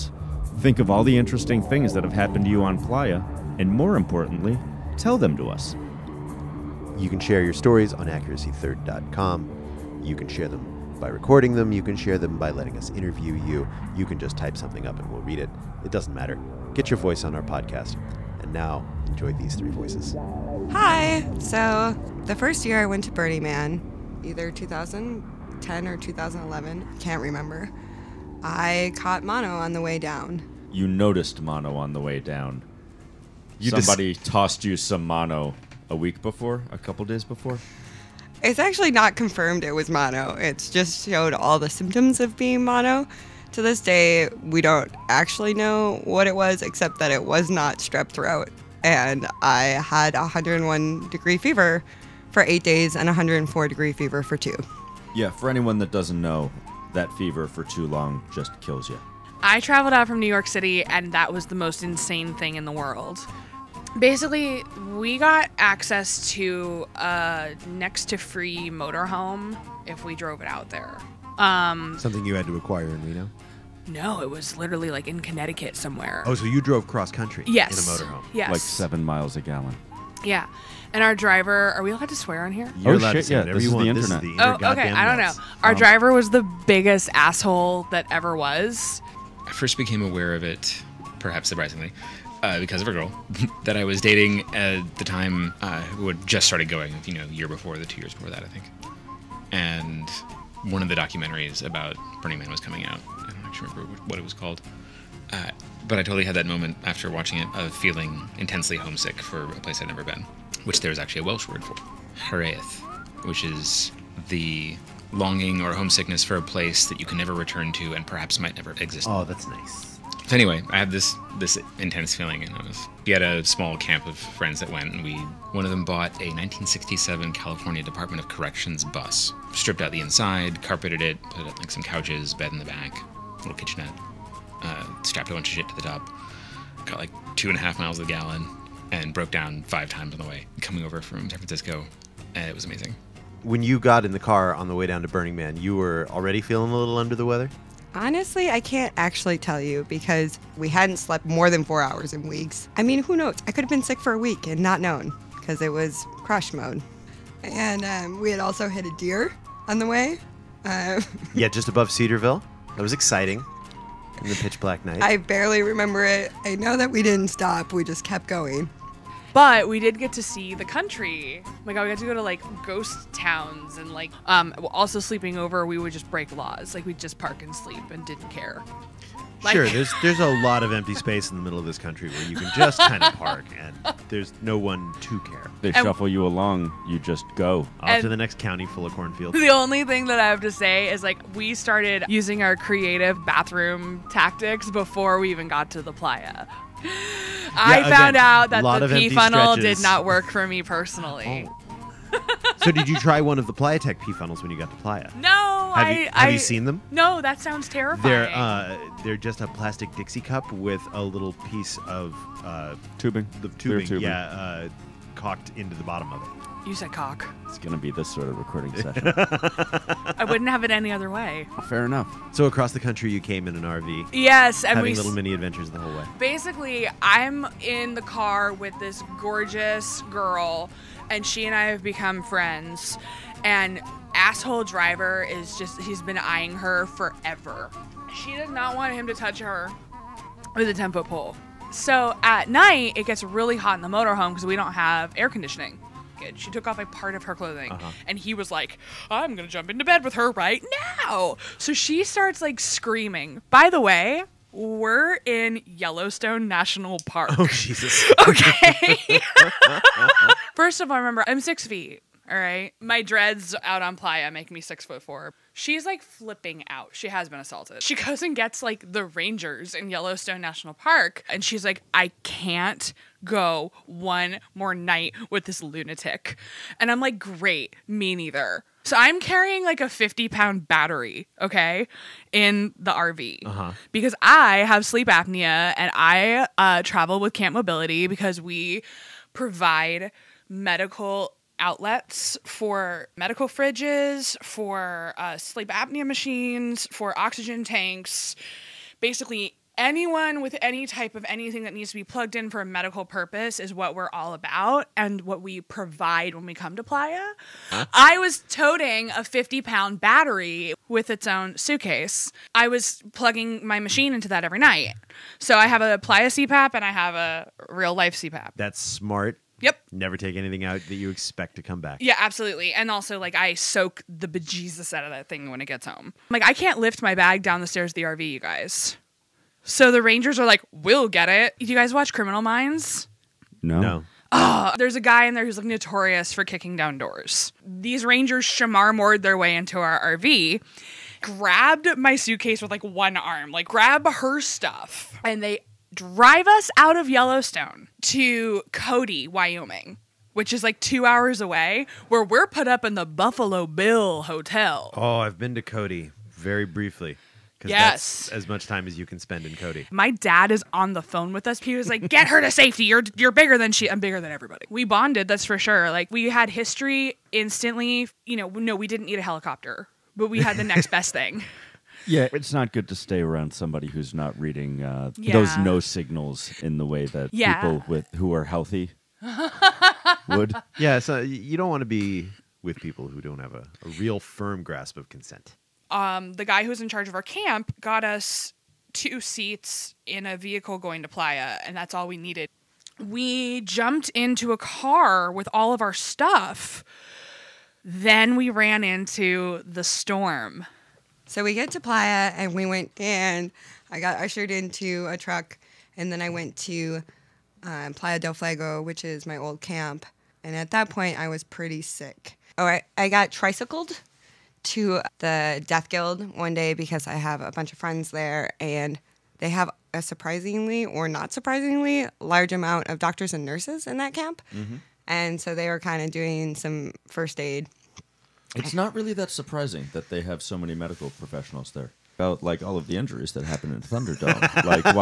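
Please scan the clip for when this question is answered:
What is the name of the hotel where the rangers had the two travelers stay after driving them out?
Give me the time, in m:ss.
5:53.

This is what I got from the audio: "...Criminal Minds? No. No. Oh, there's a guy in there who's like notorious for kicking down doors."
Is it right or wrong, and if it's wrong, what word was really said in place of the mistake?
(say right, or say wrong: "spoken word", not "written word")
right.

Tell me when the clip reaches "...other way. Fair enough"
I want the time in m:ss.
3:40.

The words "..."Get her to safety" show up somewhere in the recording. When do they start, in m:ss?
6:02.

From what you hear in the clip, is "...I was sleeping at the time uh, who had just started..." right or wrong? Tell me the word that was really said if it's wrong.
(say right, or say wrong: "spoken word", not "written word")
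wrong: "dating", not "sleeping".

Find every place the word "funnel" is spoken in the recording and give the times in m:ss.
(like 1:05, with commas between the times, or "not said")
3:19, 3:24.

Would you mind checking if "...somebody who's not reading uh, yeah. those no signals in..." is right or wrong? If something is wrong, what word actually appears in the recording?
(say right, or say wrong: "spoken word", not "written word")
right.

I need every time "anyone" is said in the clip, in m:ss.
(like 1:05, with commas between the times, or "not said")
0:55, 4:59.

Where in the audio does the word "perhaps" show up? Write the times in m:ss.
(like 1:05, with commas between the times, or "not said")
1:31, 1:58.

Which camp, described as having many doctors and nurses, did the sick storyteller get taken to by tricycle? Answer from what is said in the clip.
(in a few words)
Death Guild.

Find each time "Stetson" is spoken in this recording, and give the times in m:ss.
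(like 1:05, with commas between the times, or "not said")
not said.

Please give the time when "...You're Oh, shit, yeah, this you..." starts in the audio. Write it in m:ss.
1:22.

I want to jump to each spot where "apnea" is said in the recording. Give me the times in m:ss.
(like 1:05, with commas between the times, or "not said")
4:45, 4:55.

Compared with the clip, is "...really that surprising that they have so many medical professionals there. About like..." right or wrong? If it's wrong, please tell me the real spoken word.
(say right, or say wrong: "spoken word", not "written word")
right.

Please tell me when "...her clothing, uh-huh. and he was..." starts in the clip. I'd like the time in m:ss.
4:07.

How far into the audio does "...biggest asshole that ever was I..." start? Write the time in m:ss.
1:26.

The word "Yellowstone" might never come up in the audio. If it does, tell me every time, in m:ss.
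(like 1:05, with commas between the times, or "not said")
4:15, 4:29, 5:47.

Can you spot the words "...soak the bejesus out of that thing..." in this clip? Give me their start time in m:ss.
5:23.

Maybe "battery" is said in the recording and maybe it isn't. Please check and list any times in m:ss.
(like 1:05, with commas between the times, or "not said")
4:40, 5:09.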